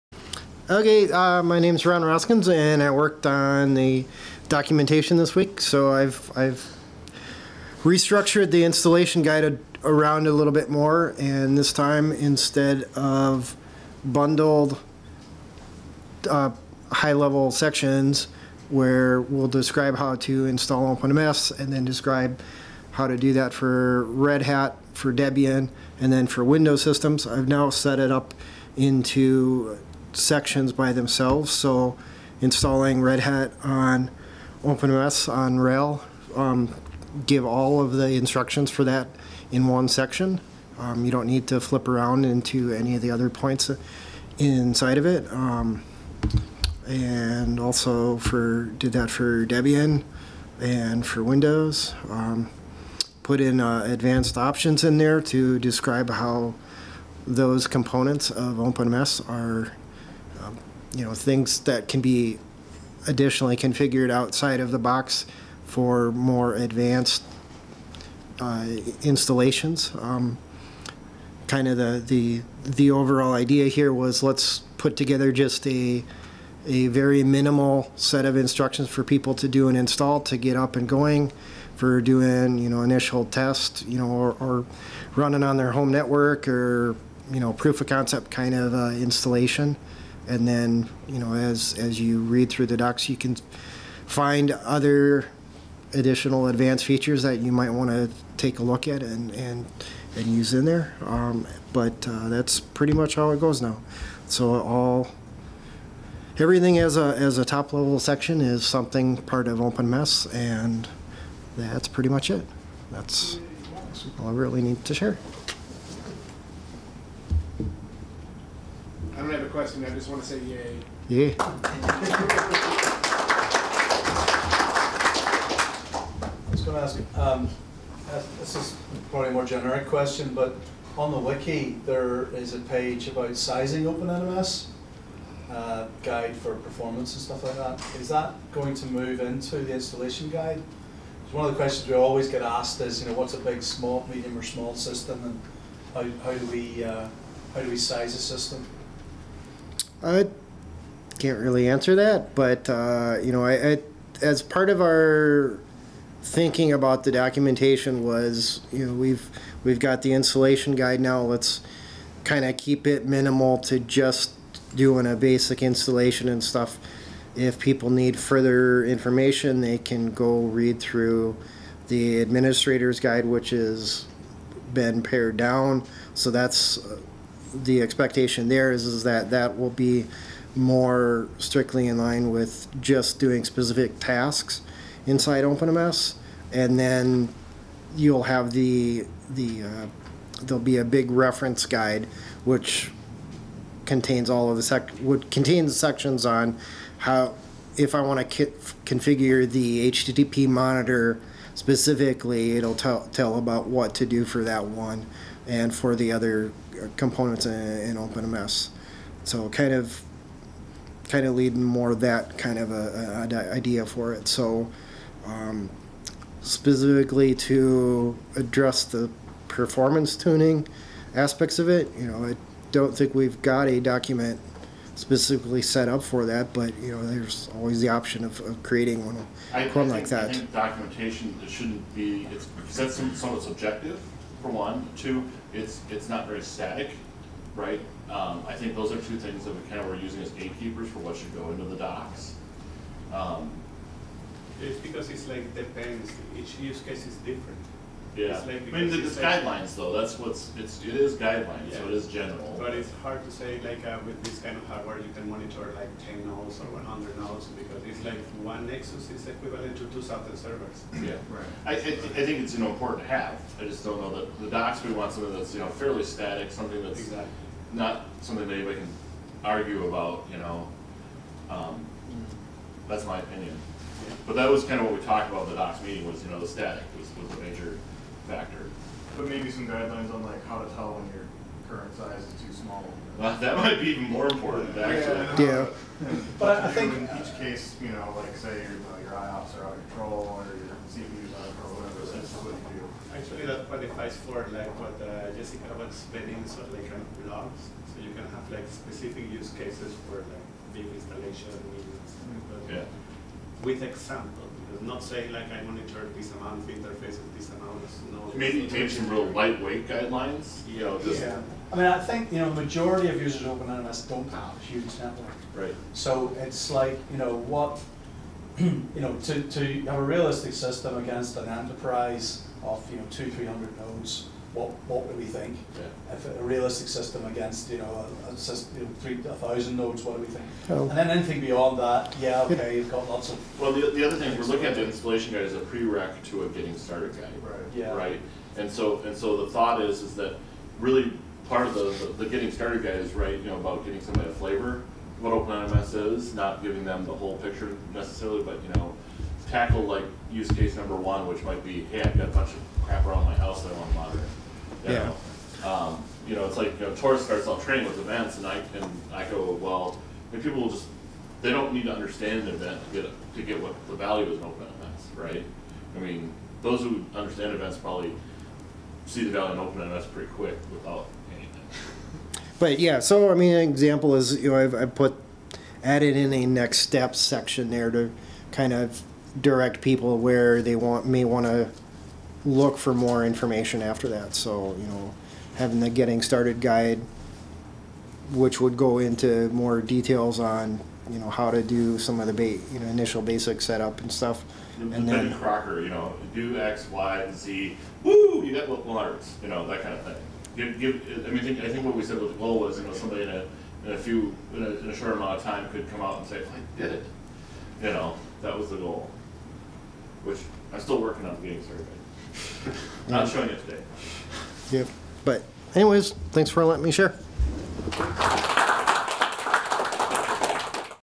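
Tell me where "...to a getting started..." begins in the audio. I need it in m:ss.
5:36.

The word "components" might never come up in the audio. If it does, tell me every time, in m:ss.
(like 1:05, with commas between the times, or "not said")
0:57, 3:26.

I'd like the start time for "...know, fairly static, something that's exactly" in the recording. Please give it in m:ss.
4:25.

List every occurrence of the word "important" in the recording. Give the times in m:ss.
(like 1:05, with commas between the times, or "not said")
4:22, 4:44.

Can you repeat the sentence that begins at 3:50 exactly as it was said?
I think documentation it shouldn't be it's because that's somewhat subjective for one.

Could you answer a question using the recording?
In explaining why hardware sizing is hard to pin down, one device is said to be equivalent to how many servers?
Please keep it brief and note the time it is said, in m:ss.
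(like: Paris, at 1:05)
2000, at 4:19.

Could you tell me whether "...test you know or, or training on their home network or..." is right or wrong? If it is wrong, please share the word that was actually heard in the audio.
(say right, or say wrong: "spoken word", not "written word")
wrong: "running", not "training".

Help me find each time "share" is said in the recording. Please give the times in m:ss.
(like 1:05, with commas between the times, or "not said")
1:54, 6:56.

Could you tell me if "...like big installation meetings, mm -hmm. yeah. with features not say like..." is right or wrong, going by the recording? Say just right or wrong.
wrong.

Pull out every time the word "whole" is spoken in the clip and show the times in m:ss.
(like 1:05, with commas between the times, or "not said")
5:47.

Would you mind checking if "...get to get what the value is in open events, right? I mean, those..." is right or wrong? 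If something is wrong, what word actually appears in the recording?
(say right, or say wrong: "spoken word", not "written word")
right.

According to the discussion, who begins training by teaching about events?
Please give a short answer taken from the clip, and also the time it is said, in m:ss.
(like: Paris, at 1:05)
Tarus, at 5:56.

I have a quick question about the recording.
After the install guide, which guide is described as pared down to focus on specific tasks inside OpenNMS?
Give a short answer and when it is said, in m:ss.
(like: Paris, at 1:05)
administrator's guide, at 2:52.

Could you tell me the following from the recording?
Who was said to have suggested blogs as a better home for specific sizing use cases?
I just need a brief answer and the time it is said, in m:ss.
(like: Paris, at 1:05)
Jessica, at 4:55.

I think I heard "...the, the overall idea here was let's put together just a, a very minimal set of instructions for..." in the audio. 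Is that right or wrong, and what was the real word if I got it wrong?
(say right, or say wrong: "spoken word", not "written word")
right.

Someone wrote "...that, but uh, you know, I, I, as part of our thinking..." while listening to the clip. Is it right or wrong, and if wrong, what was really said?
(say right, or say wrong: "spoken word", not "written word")
right.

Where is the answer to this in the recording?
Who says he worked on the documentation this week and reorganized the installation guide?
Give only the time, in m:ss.
0:01.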